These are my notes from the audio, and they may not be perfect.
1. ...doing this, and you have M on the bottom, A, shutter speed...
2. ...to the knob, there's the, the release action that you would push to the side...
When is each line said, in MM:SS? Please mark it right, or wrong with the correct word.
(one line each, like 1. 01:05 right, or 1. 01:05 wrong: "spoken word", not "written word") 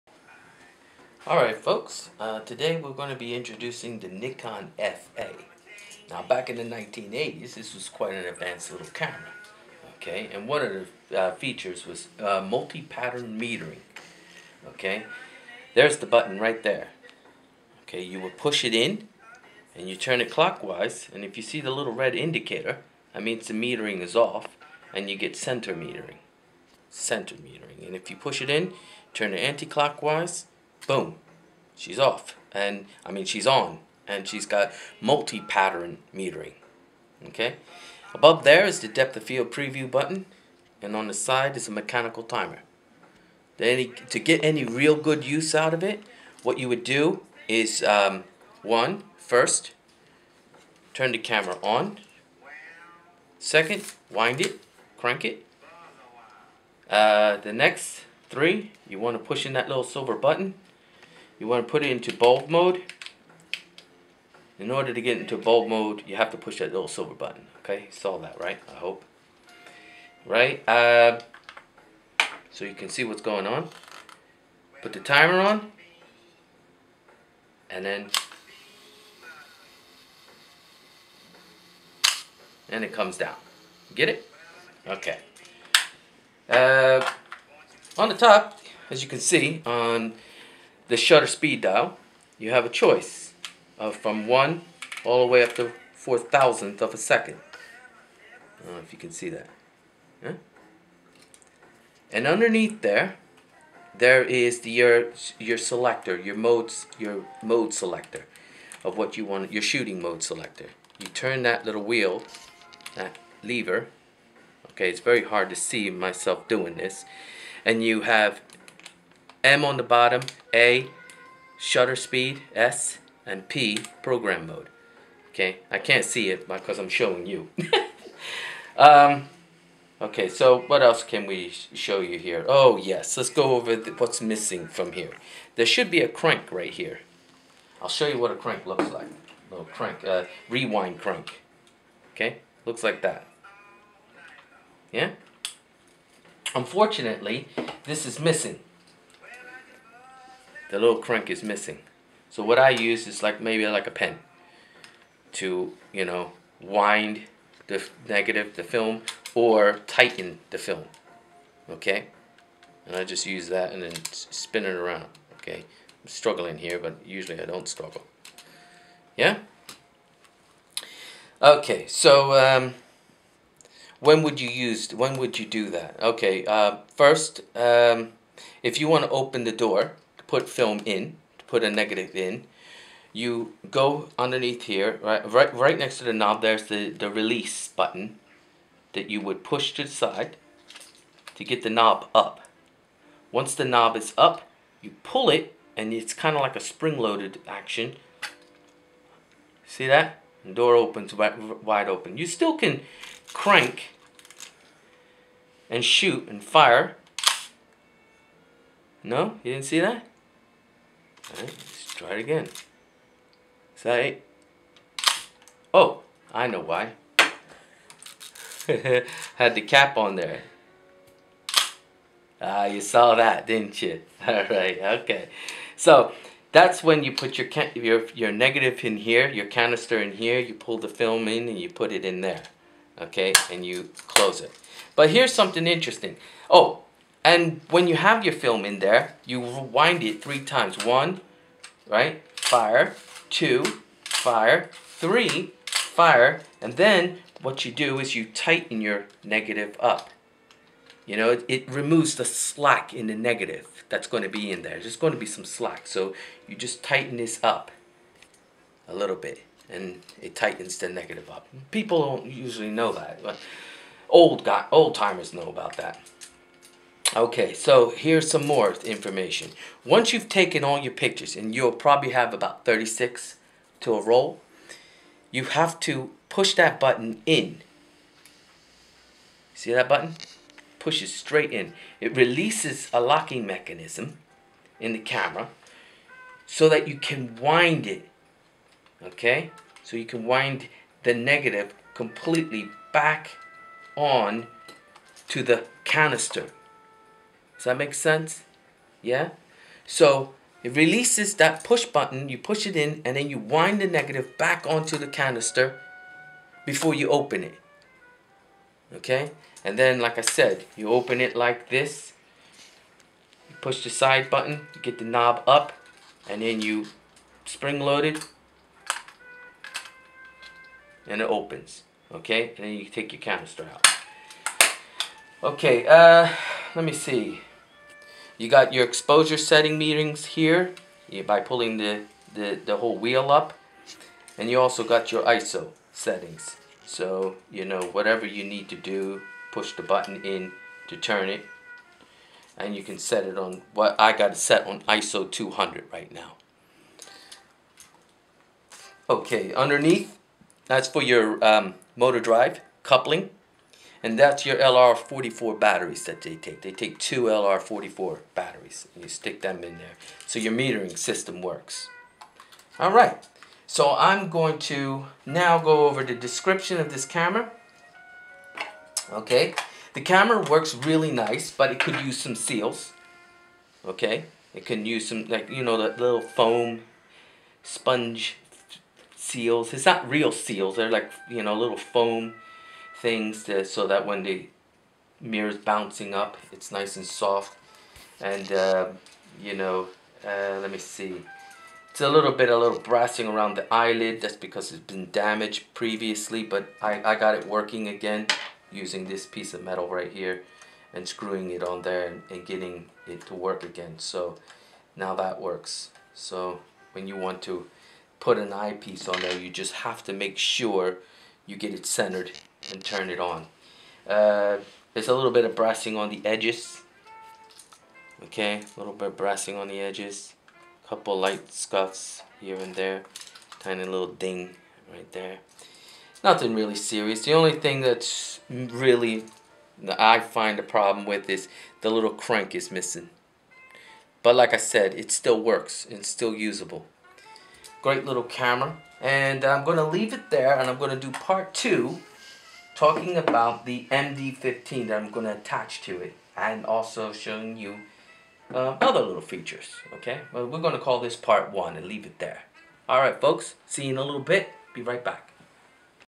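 1. 01:56 right
2. 03:05 wrong: "button", not "action".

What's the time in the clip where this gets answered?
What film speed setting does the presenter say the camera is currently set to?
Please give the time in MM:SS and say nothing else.
05:44.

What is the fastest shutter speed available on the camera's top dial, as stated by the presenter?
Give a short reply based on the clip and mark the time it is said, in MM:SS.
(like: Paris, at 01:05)
1/4000 second, at 01:35.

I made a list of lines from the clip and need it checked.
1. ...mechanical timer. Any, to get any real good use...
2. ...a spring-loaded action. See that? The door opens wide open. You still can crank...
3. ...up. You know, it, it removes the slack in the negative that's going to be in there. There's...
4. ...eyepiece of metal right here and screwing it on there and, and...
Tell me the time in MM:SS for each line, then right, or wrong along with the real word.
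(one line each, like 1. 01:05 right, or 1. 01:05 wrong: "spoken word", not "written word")
1. 00:41 right
2. 03:16 right
3. 04:09 right
4. 06:39 wrong: "piece", not "eyepiece".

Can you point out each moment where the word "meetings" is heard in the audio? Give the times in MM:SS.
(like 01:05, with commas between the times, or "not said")
05:29.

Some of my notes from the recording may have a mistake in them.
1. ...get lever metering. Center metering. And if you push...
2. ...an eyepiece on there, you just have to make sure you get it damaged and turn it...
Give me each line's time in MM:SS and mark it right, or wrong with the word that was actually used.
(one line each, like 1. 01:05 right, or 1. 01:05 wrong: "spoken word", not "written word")
1. 00:25 wrong: "center", not "lever"
2. 06:48 wrong: "centered", not "damaged".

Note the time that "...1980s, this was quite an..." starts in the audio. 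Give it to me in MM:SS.
00:06.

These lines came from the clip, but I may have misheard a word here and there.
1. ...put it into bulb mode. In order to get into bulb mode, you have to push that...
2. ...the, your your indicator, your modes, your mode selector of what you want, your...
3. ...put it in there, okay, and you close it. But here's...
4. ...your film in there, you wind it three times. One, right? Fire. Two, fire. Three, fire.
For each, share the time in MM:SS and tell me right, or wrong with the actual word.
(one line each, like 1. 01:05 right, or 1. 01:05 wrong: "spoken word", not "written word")
1. 01:01 right
2. 01:44 wrong: "selector", not "indicator"
3. 03:51 right
4. 03:58 right.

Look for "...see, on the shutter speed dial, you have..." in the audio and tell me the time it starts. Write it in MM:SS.
01:29.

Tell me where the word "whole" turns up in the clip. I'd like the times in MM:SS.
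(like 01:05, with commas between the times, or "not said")
05:32.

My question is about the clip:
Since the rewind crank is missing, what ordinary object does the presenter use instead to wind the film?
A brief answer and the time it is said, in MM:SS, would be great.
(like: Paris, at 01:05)
A pen, at 02:33.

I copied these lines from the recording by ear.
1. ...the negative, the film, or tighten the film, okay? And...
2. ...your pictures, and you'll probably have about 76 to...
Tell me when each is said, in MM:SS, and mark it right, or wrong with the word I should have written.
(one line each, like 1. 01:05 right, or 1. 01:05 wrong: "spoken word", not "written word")
1. 02:37 right
2. 04:30 wrong: "36", not "76".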